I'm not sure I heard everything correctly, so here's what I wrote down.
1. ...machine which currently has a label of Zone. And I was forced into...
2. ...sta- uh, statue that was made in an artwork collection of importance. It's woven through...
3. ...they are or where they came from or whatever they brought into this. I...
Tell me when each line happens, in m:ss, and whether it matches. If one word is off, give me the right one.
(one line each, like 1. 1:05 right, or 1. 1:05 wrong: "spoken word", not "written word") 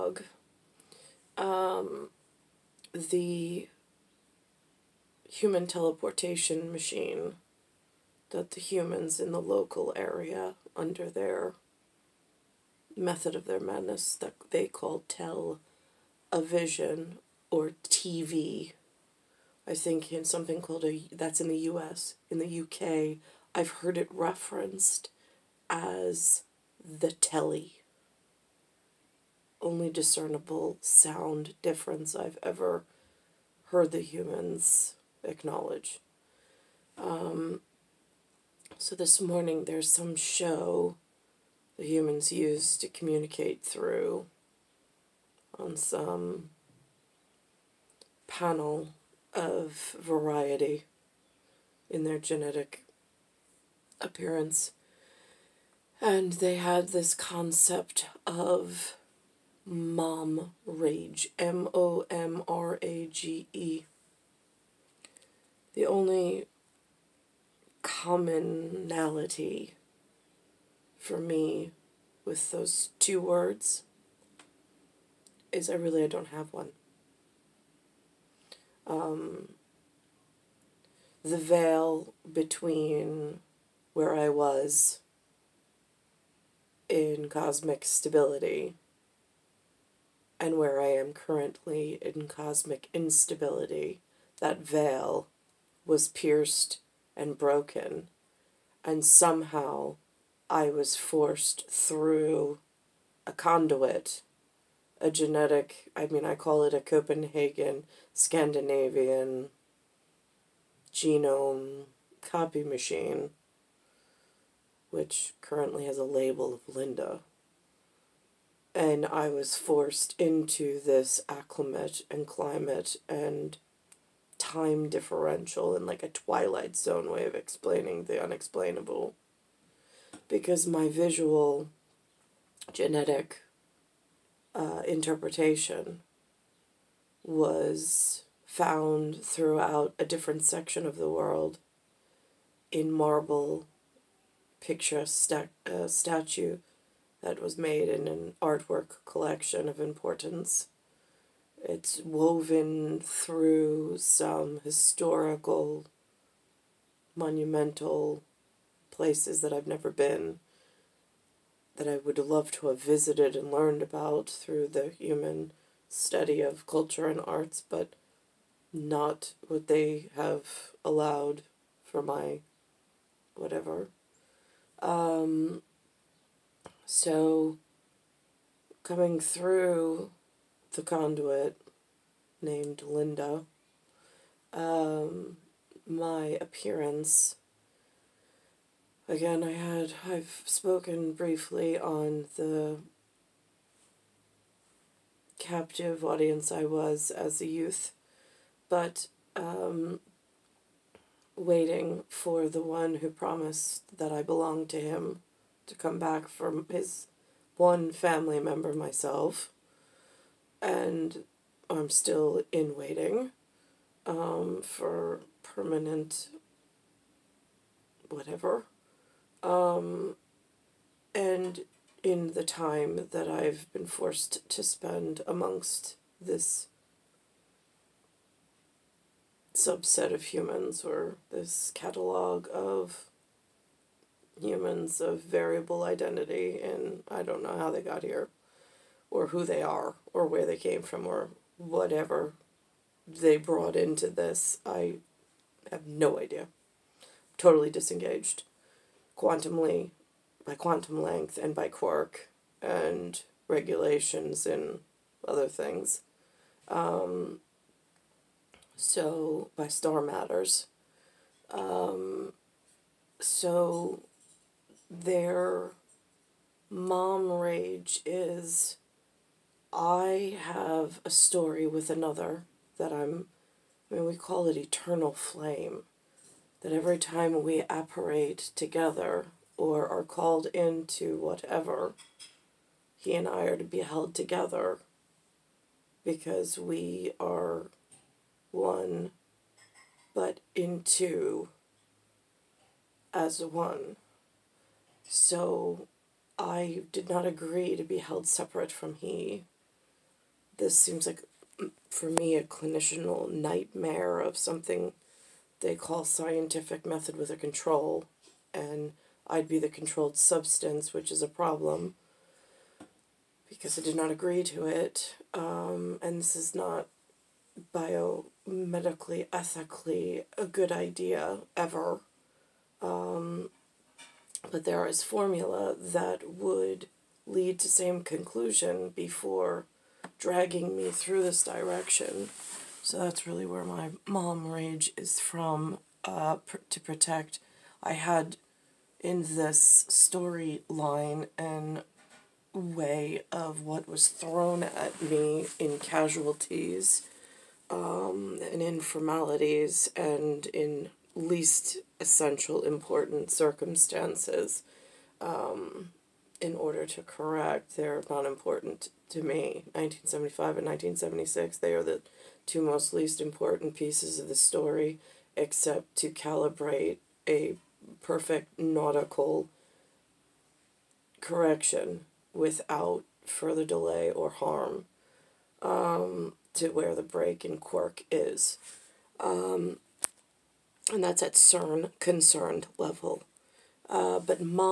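1. 1:52 wrong: "Linda", not "Zone"
2. 2:25 right
3. 3:59 right.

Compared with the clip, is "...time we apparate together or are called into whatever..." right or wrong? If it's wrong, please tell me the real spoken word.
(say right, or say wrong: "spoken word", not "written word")
right.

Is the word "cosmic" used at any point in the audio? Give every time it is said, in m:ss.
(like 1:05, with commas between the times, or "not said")
1:27, 1:32.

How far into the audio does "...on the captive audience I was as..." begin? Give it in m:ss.
3:11.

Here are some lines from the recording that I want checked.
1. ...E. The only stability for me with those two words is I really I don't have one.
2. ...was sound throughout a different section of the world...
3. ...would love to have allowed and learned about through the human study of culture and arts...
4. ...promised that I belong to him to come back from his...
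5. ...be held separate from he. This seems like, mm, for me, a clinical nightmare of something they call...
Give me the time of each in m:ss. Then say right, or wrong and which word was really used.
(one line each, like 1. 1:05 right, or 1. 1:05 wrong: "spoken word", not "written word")
1. 1:03 wrong: "commonality", not "stability"
2. 2:17 wrong: "found", not "sound"
3. 2:41 wrong: "visited", not "allowed"
4. 3:23 right
5. 4:57 right.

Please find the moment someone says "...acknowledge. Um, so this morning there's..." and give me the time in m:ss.
0:35.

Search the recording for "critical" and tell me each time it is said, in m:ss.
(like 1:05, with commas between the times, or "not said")
not said.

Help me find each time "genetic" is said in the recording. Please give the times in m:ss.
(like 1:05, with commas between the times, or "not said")
0:52, 1:45, 2:12.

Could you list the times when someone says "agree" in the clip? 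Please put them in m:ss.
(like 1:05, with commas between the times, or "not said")
4:57, 5:14.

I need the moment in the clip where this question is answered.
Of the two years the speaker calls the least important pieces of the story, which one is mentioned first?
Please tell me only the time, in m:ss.
5:59.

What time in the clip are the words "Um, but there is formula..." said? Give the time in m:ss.
5:22.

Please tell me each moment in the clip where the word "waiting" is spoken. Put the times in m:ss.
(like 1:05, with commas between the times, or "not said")
3:21, 3:32.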